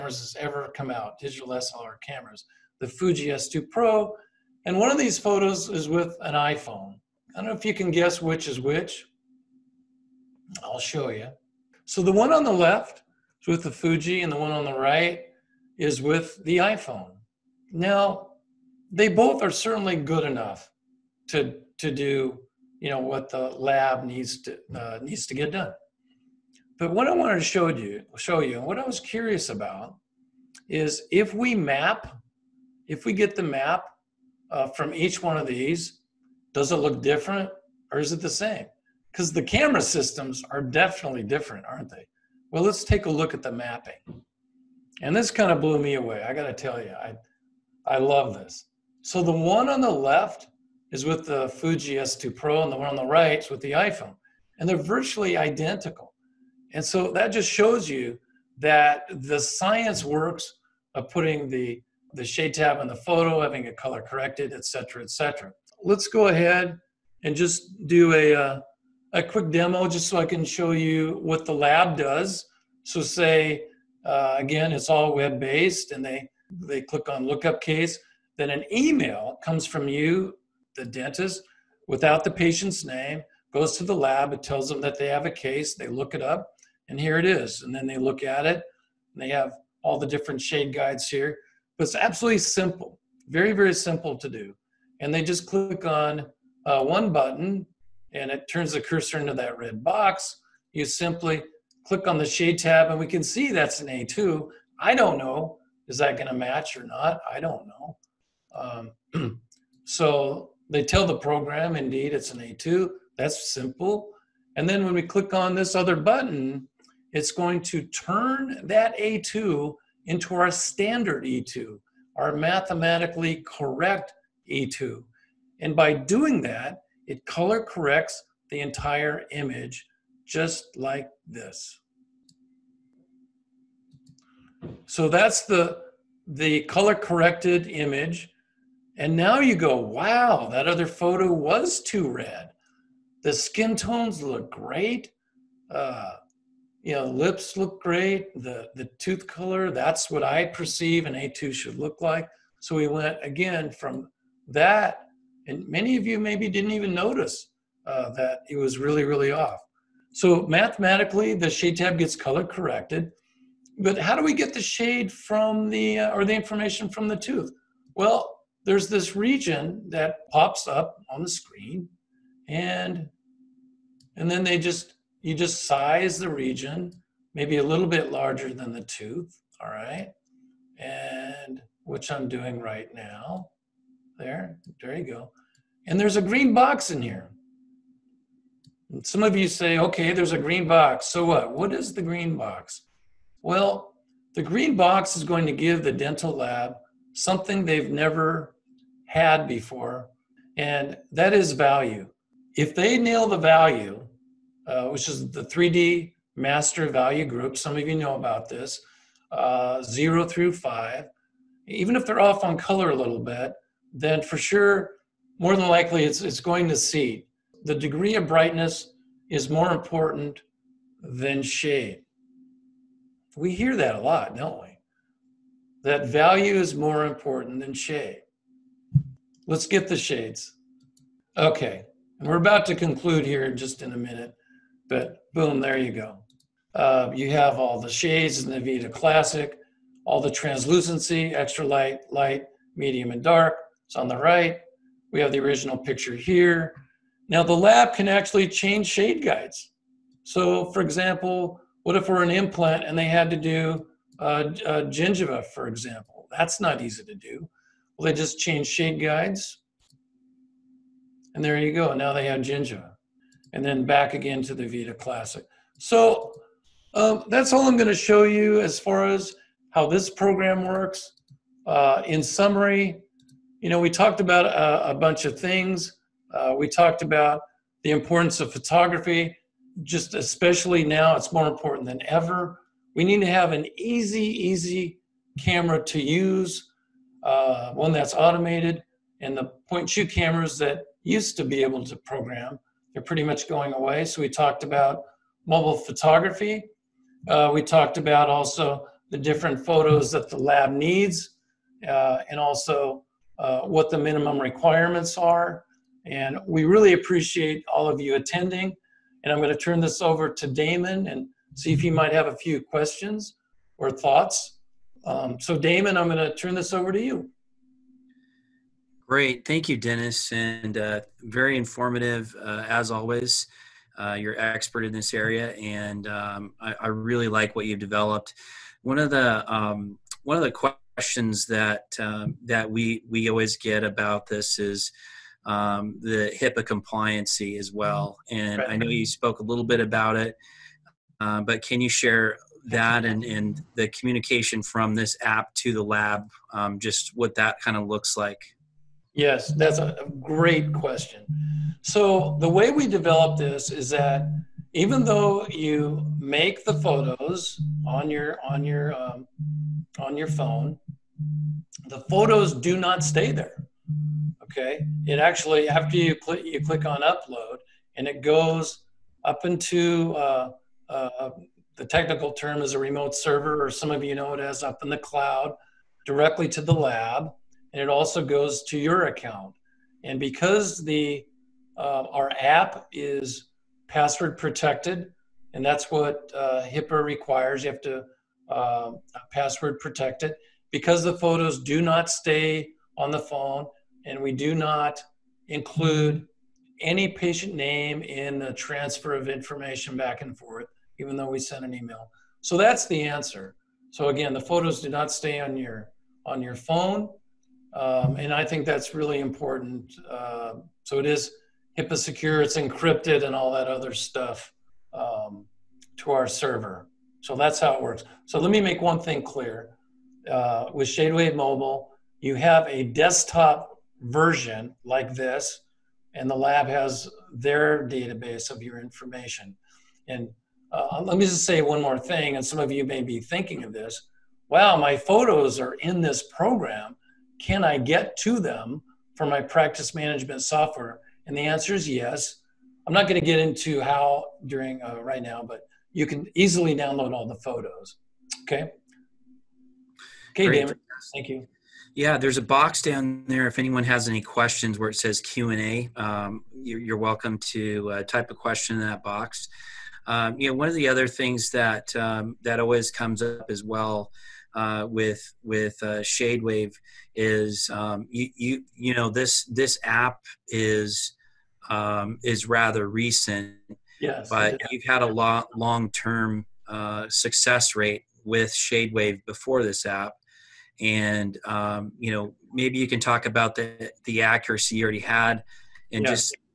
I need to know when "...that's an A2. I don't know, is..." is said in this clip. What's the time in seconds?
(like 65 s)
103 s.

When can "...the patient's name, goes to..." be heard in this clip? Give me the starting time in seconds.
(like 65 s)
82 s.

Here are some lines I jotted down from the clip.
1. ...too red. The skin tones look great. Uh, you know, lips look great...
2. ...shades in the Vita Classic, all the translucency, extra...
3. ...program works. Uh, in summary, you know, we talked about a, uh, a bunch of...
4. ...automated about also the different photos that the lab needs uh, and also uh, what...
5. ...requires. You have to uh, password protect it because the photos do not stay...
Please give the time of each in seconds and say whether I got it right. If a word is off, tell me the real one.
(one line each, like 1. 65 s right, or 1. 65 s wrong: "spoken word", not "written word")
1. 141 s right
2. 237 s right
3. 270 s right
4. 297 s wrong: "talked", not "automated"
5. 387 s right.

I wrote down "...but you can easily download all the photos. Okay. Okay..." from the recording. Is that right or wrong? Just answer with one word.
right.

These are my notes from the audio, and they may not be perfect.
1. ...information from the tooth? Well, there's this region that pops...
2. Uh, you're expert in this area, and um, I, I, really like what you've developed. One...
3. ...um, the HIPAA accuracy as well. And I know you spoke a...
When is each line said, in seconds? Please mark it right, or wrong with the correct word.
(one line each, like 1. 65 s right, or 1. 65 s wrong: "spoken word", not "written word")
1. 166 s right
2. 323 s right
3. 335 s wrong: "compliancy", not "accuracy".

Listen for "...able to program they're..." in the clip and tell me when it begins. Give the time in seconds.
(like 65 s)
291 s.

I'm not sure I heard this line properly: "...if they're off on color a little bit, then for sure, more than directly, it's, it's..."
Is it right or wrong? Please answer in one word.
wrong.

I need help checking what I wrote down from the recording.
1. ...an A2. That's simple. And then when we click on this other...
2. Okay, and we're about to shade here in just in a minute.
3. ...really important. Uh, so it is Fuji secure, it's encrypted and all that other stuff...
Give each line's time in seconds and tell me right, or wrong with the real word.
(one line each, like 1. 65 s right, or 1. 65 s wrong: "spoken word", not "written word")
1. 112 s right
2. 231 s wrong: "conclude", not "shade"
3. 408 s wrong: "HIPAA", not "Fuji".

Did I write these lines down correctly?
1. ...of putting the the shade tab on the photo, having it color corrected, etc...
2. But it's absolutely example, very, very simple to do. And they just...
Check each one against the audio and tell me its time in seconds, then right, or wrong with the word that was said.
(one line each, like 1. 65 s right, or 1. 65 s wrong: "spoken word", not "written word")
1. 60 s right
2. 91 s wrong: "simple", not "example".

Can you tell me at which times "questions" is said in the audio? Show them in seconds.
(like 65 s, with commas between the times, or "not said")
312 s, 330 s, 350 s, 454 s, 458 s.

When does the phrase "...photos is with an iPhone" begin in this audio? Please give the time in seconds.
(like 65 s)
5 s.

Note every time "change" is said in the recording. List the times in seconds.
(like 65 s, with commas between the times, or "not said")
248 s, 258 s.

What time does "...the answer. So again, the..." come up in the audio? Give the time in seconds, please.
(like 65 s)
402 s.